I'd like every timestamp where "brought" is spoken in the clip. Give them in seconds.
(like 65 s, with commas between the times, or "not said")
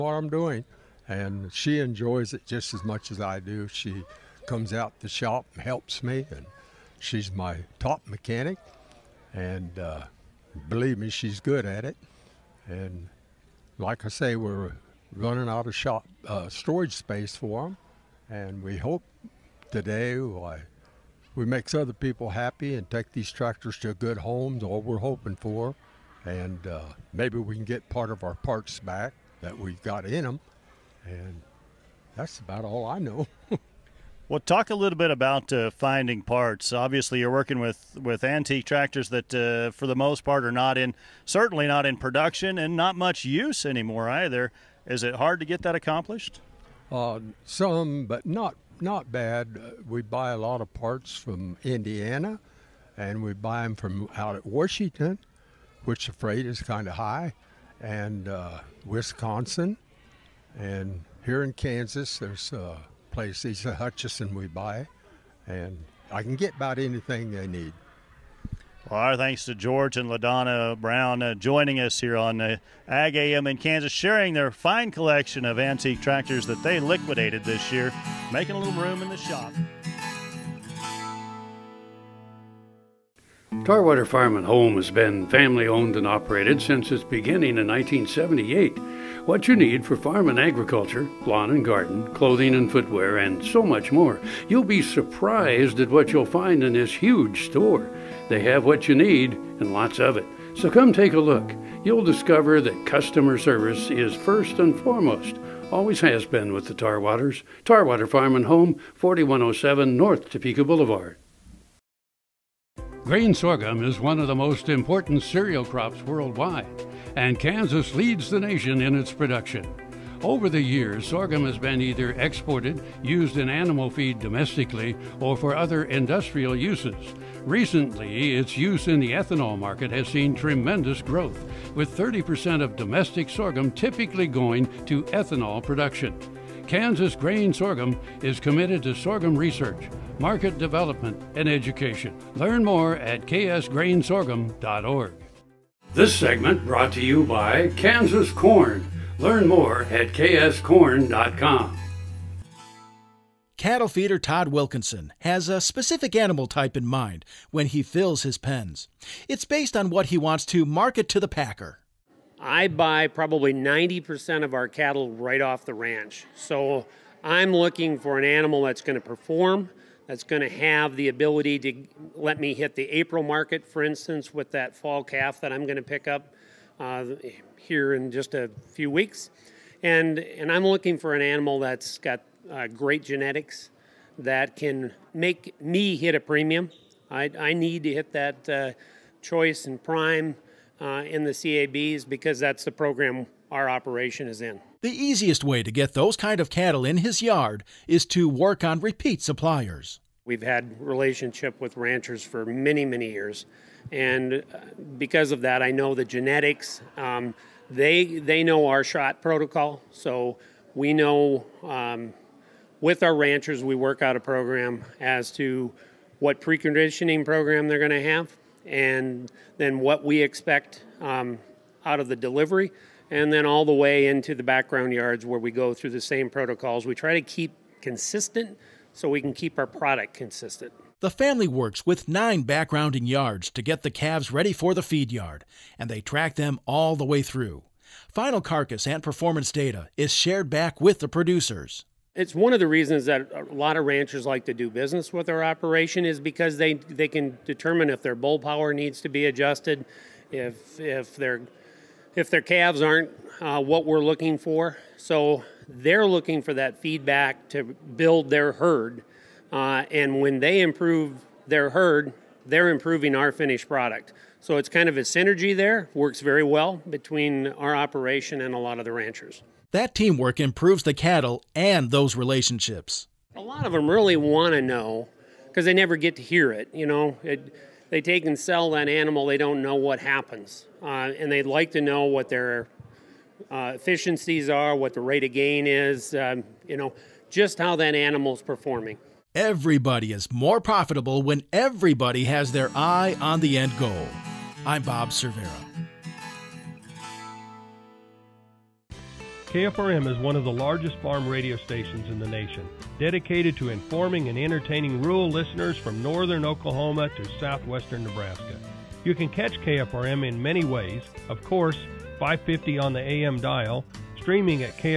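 146 s.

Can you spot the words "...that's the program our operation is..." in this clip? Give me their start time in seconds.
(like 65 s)
192 s.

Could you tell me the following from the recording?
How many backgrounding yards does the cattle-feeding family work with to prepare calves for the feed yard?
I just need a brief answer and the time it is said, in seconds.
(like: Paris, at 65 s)
9, at 232 s.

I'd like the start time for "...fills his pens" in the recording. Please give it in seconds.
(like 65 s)
157 s.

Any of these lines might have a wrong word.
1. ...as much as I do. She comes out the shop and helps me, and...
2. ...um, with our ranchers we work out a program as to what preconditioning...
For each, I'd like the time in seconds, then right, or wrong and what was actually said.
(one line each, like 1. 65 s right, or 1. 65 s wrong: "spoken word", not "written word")
1. 2 s right
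2. 211 s right.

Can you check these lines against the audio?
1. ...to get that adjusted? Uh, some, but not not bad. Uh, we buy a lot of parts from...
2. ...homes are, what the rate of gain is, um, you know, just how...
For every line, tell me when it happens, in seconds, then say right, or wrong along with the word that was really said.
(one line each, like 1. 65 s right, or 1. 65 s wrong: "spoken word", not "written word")
1. 45 s wrong: "accomplished", not "adjusted"
2. 283 s wrong: "efficiencies", not "homes".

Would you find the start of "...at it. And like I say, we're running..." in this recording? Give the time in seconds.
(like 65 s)
11 s.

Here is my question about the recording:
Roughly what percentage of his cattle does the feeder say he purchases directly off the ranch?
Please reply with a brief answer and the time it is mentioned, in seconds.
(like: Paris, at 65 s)
90%, at 163 s.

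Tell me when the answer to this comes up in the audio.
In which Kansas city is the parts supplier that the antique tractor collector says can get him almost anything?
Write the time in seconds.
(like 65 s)
63 s.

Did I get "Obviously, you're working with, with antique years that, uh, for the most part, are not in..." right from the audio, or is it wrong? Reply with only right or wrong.
wrong.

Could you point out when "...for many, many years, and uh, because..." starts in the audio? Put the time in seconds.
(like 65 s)
202 s.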